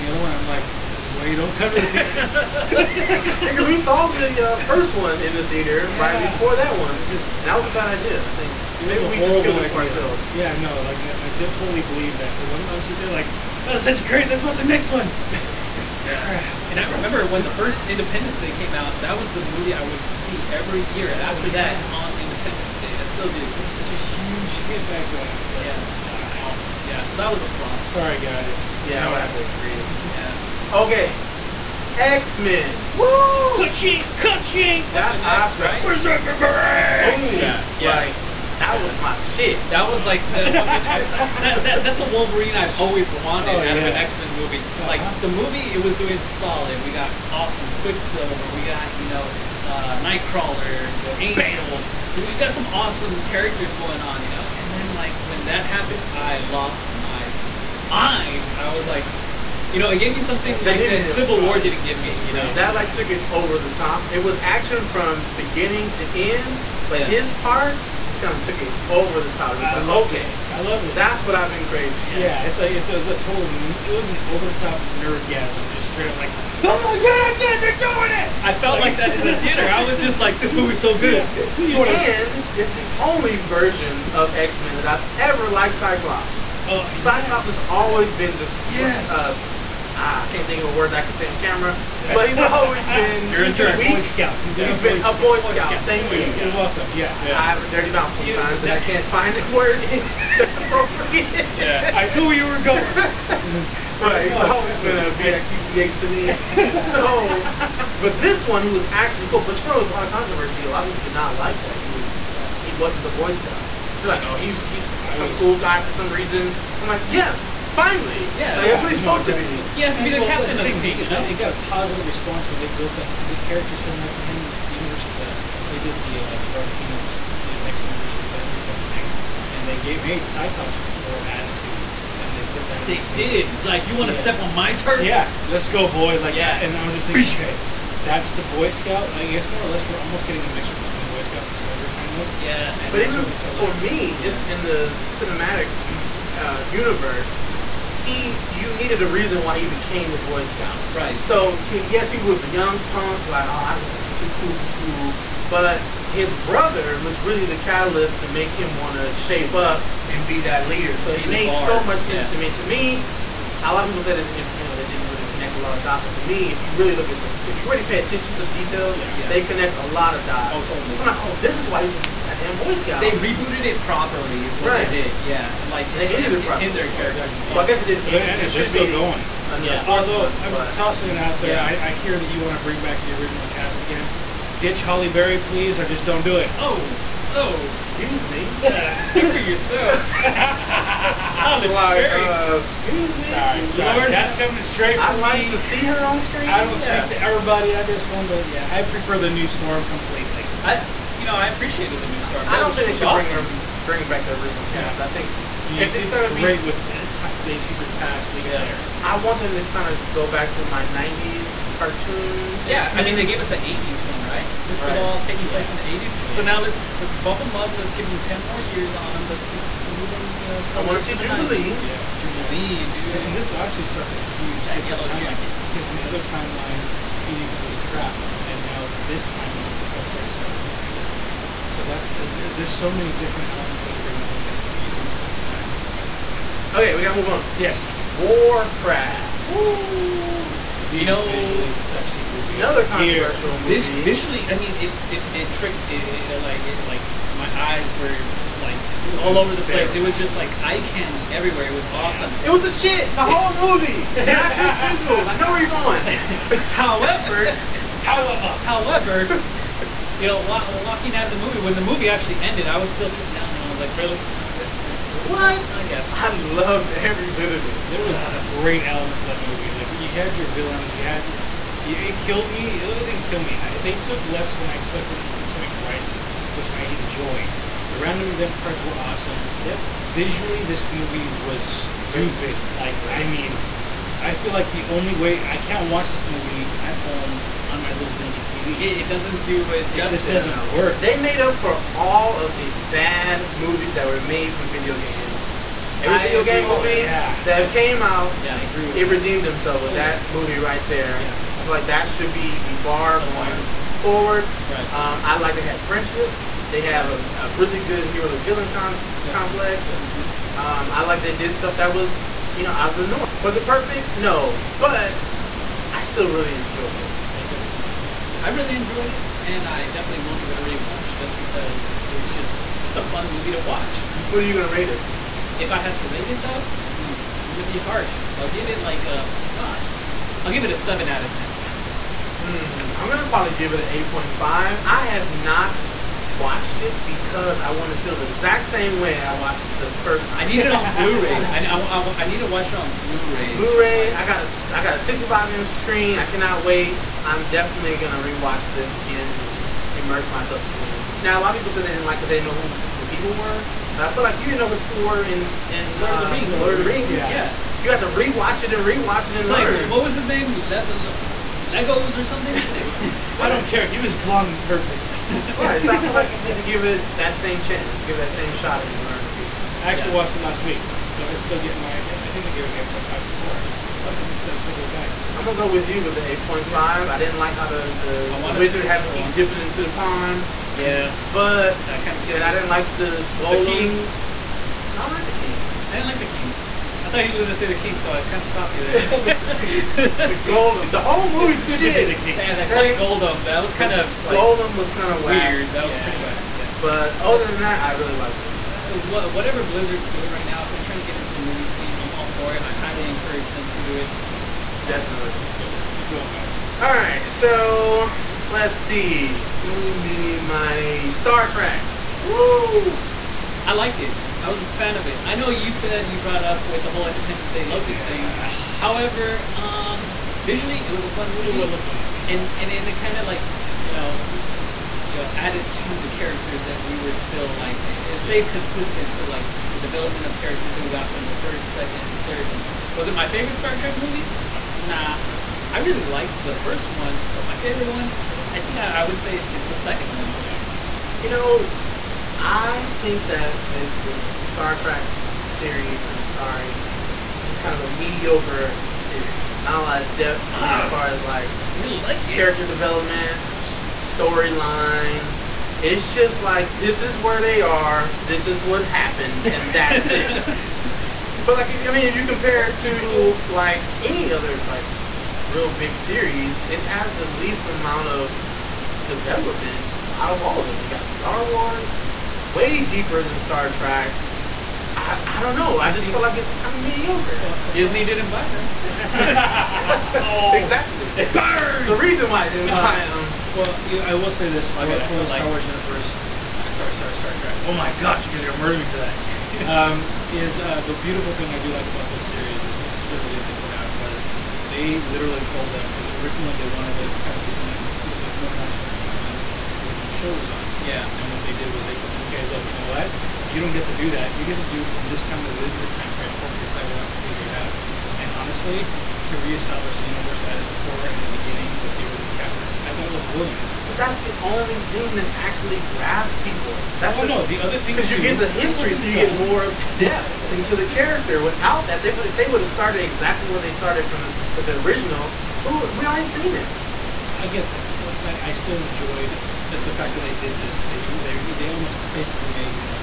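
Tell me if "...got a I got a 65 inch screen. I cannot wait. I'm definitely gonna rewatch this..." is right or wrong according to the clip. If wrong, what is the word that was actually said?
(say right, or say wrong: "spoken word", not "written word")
right.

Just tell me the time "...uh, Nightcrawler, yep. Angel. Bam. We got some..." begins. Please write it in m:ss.
0:49.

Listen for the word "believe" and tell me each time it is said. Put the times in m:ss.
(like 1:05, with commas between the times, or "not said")
0:11.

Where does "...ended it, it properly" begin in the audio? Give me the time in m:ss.
2:56.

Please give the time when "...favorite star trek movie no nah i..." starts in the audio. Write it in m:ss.
7:13.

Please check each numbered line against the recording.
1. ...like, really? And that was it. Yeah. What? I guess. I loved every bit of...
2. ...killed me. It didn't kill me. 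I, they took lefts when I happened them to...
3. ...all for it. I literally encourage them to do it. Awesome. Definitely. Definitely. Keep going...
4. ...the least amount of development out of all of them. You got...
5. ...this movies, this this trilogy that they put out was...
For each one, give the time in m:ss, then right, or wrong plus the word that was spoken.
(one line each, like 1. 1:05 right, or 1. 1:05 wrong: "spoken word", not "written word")
1. 4:23 right
2. 4:32 wrong: "expected", not "happened"
3. 6:42 wrong: "highly", not "literally"
4. 7:47 right
5. 8:12 wrong: "series", not "movies".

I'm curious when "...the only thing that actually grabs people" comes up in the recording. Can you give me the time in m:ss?
8:34.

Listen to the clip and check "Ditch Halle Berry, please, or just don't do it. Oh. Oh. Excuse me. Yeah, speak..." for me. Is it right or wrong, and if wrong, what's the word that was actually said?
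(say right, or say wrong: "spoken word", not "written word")
right.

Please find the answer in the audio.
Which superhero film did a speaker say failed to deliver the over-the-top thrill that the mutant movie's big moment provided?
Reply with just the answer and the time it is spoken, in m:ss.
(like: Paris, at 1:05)
Civil War, at 1:01.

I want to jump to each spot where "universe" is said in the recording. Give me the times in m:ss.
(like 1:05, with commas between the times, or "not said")
2:04, 2:26, 8:05, 8:30.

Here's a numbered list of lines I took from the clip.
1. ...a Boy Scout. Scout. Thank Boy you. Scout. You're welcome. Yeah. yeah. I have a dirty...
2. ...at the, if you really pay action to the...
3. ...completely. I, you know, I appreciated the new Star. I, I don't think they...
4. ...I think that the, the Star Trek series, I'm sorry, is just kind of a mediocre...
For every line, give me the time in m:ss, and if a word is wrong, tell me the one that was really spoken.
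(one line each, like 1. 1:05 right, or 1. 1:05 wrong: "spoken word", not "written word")
1. 1:35 right
2. 2:47 wrong: "attention", not "action"
3. 3:19 wrong: "Storm", not "Star"
4. 7:22 right.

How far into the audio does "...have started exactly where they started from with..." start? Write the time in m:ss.
8:42.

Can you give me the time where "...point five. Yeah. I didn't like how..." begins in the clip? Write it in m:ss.
6:16.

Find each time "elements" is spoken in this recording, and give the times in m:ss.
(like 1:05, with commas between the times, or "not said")
3:53, 4:28.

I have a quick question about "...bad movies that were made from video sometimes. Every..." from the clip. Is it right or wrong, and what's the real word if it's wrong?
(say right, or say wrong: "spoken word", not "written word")
wrong: "games", not "sometimes".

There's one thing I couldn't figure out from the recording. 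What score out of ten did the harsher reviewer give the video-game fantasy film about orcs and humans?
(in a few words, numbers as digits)
7.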